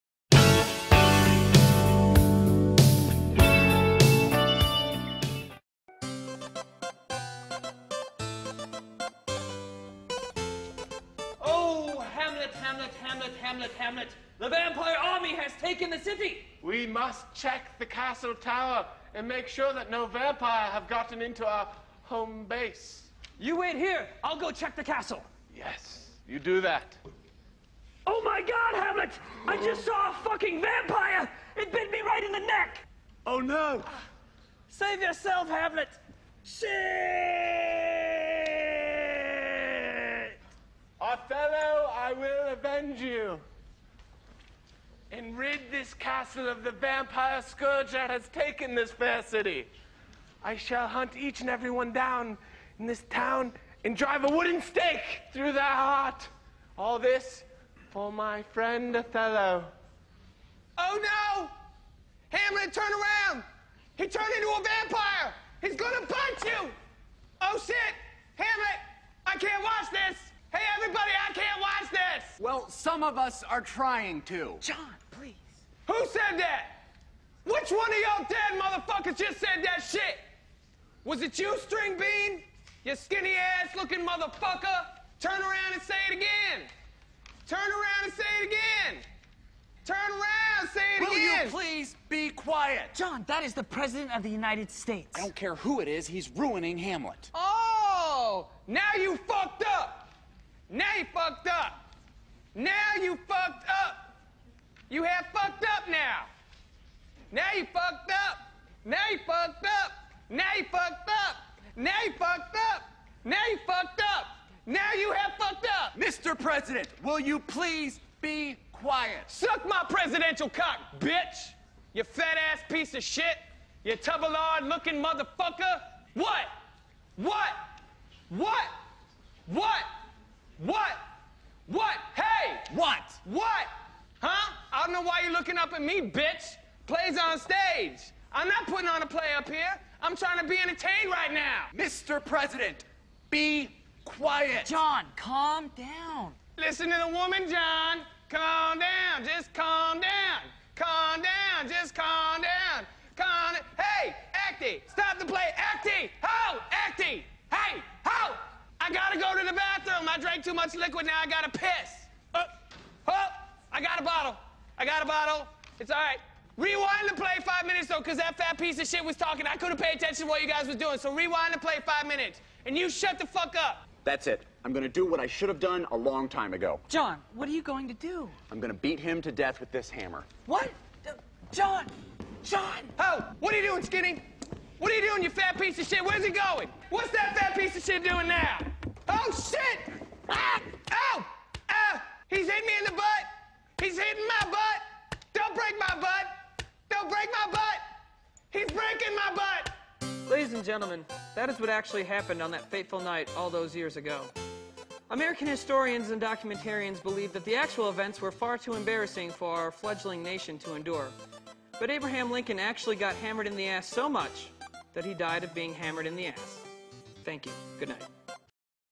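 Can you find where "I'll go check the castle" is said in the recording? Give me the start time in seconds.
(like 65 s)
24 s.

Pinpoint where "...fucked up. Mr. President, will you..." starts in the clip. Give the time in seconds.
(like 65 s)
115 s.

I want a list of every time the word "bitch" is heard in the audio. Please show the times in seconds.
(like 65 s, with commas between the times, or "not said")
120 s, 136 s.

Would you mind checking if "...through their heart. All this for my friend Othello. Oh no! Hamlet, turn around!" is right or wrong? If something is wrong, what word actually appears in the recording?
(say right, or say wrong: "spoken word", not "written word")
right.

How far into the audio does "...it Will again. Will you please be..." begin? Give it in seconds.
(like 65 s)
90 s.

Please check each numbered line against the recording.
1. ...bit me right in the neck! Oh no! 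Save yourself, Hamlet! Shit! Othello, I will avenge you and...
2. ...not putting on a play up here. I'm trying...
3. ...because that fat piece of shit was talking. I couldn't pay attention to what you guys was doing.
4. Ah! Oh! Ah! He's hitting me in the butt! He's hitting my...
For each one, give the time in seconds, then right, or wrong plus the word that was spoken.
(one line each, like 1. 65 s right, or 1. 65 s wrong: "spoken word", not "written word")
1. 31 s right
2. 138 s right
3. 167 s right
4. 190 s right.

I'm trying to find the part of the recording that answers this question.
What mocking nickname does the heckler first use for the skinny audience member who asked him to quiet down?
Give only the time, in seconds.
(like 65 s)
81 s.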